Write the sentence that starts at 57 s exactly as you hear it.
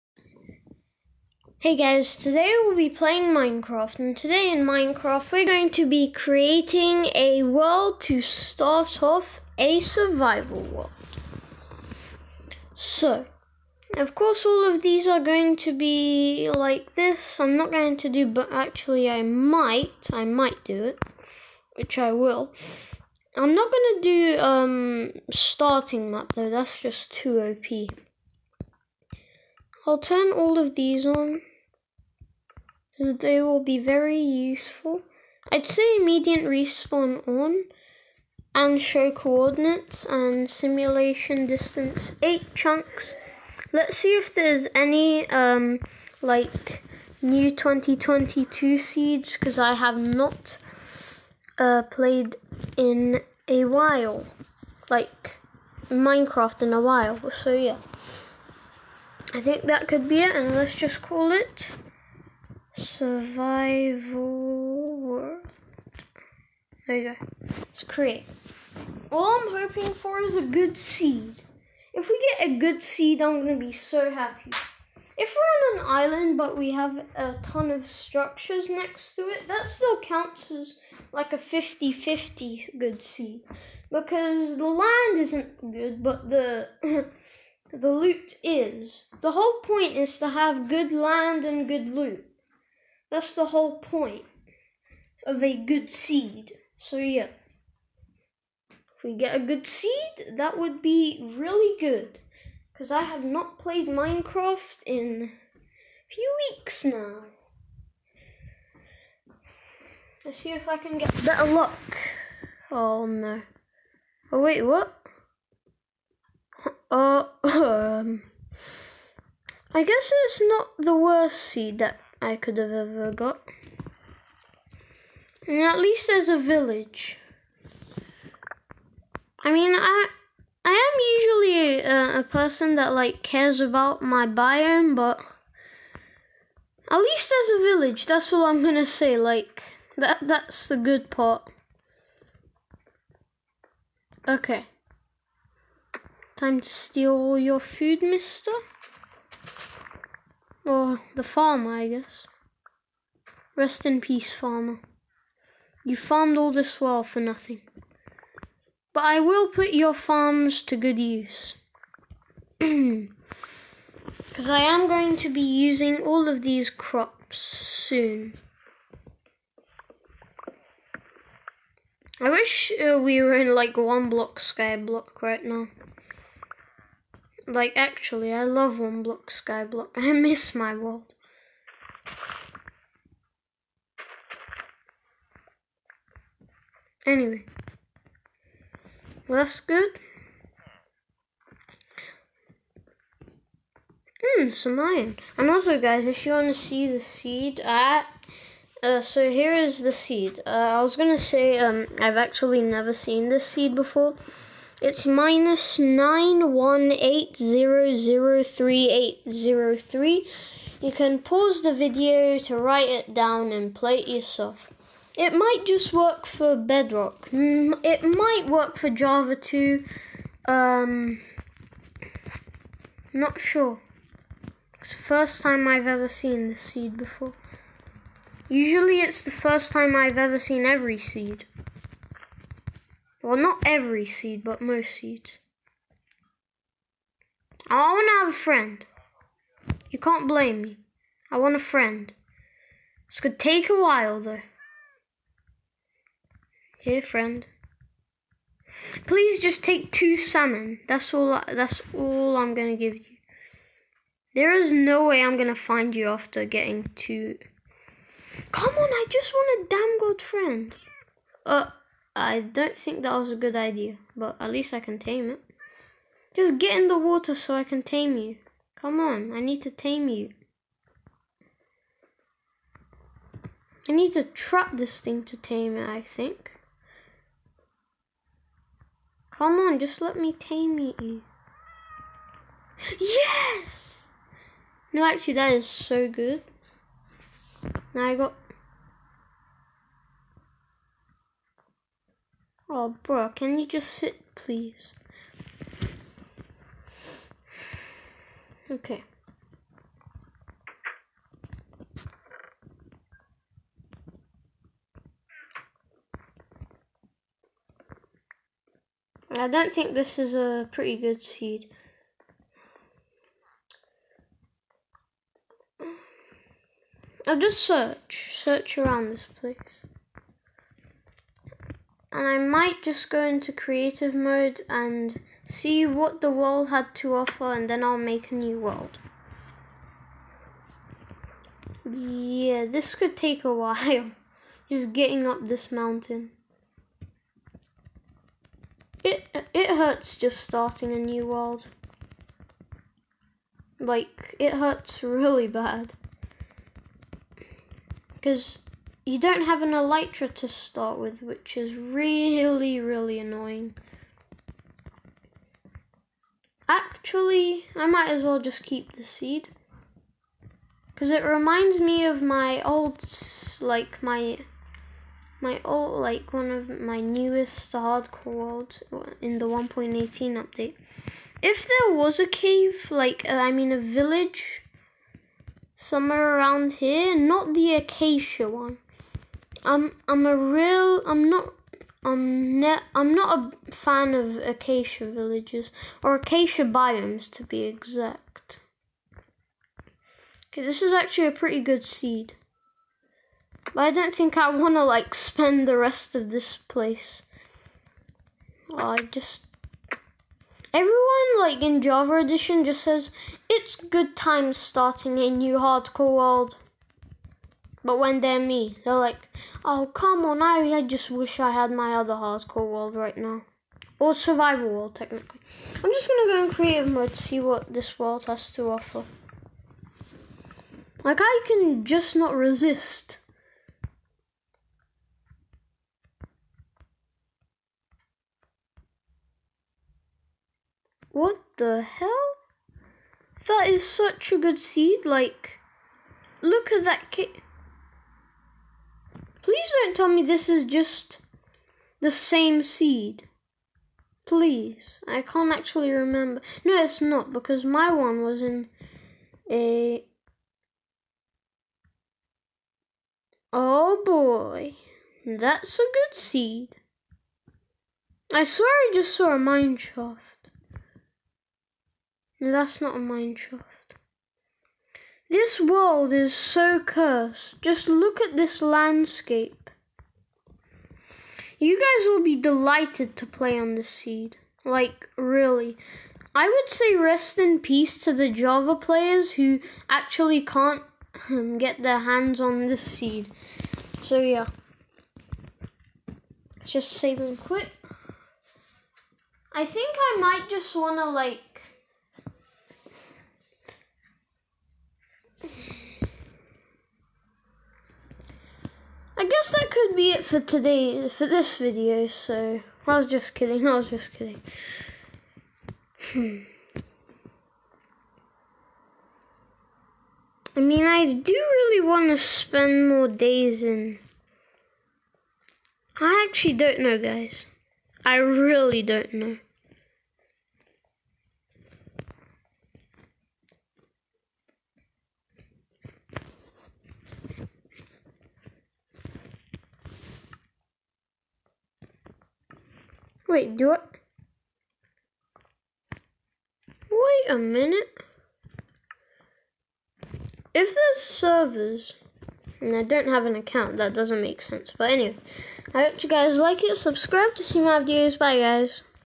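So yeah, I think that could be it, and let's just call it survival world.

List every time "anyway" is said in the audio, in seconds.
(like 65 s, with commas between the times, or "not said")
187 s, 544 s.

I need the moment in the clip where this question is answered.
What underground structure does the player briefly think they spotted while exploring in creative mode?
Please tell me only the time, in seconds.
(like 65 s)
459 s.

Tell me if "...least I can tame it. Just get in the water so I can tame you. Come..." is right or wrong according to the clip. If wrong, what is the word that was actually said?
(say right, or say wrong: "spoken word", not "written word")
right.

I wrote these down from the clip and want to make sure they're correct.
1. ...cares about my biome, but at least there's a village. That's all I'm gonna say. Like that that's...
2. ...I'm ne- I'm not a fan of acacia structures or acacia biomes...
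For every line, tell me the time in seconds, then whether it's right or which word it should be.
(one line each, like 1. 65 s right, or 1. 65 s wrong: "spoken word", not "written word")
1. 133 s right
2. 382 s wrong: "villages", not "structures".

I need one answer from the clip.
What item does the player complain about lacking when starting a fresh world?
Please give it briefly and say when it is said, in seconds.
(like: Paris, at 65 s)
Elytra, at 349 s.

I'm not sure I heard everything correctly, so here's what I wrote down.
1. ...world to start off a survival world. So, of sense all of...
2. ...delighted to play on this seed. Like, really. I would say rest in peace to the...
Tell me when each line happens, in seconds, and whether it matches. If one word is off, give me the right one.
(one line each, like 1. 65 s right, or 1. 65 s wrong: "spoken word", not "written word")
1. 7 s wrong: "course", not "sense"
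2. 472 s right.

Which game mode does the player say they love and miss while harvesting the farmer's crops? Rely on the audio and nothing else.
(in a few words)
One block skyblock.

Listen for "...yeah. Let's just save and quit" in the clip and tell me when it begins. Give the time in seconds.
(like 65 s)
484 s.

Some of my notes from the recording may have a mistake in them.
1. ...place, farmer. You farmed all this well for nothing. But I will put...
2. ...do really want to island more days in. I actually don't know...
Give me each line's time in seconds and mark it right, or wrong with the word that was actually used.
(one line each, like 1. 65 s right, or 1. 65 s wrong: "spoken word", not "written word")
1. 154 s wrong: "peace", not "place"
2. 511 s wrong: "spend", not "island".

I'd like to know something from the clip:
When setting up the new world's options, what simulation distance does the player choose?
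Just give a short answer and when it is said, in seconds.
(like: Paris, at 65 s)
8 chunks, at 42 s.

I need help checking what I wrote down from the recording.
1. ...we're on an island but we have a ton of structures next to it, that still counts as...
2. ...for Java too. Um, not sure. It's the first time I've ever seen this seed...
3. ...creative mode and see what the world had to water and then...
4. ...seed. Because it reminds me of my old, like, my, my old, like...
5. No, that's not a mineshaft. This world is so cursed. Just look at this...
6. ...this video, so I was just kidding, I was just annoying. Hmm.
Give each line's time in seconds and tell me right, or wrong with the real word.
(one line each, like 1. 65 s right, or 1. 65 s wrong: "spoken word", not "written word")
1. 75 s right
2. 218 s right
3. 323 s wrong: "offer", not "water"
4. 359 s right
5. 462 s right
6. 501 s wrong: "kidding", not "annoying".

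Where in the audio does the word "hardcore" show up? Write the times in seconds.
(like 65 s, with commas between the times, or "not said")
367 s, 405 s, 412 s.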